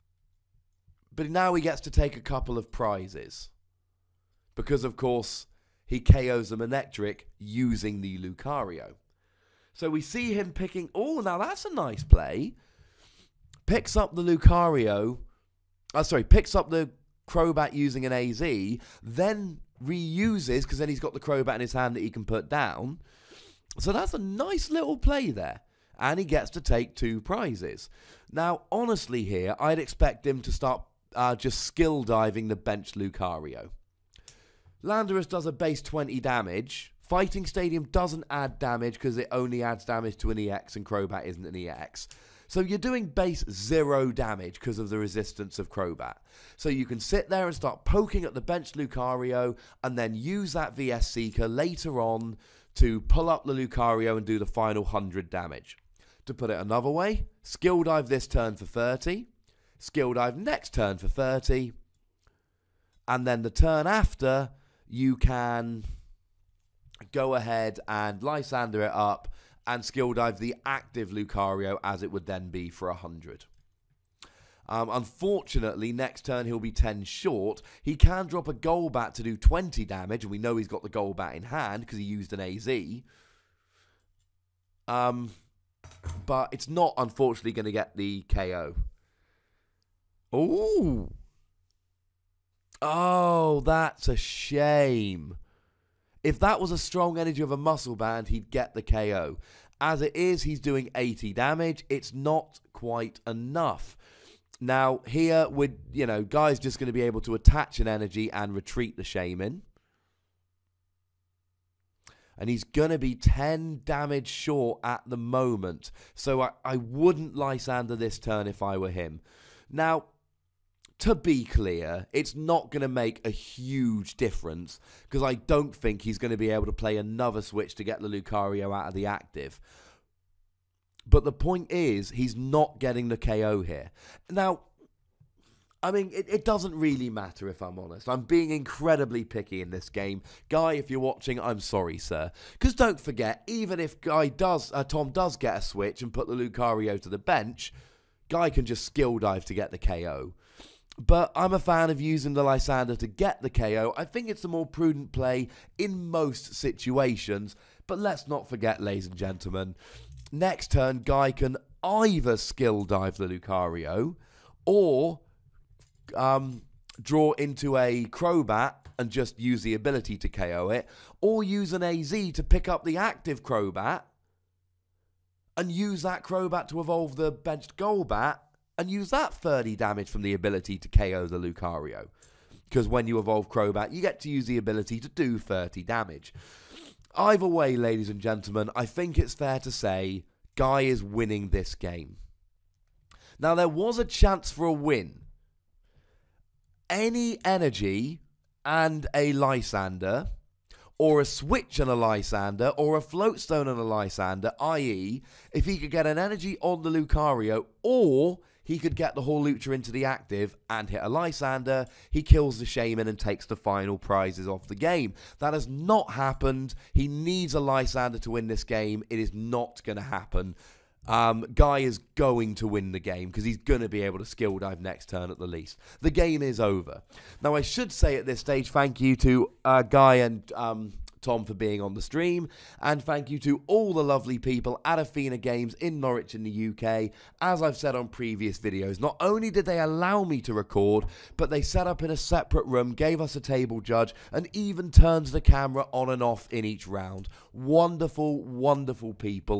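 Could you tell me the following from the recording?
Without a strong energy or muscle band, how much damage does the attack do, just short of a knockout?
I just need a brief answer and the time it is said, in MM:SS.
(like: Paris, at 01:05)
80, at 01:40.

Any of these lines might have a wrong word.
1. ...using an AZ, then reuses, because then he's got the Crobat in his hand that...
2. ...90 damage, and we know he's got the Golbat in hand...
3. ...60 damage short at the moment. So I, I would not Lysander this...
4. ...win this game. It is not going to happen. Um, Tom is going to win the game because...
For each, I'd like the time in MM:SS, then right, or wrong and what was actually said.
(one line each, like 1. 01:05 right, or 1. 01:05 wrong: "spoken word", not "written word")
1. 00:17 right
2. 01:19 wrong: "20", not "90"
3. 01:53 wrong: "10", not "60"
4. 03:38 wrong: "Guy", not "Tom".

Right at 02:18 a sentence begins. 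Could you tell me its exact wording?
I'm being incredibly picky in this game.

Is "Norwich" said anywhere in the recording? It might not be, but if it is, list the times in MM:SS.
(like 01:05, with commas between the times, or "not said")
03:56.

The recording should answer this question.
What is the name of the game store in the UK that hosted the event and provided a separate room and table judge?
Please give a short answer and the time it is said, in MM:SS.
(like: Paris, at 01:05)
Athena Games, at 03:54.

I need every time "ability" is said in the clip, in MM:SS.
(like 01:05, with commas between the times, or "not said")
02:49, 03:00, 03:04.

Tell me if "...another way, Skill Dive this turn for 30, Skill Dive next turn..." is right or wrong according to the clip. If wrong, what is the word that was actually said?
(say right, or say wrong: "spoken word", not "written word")
right.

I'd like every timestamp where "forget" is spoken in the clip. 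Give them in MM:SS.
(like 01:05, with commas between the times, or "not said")
02:23, 02:38.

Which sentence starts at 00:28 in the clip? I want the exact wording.
Now, honestly, here, I'd expect him to start uh, just skill diving the bench Lucario.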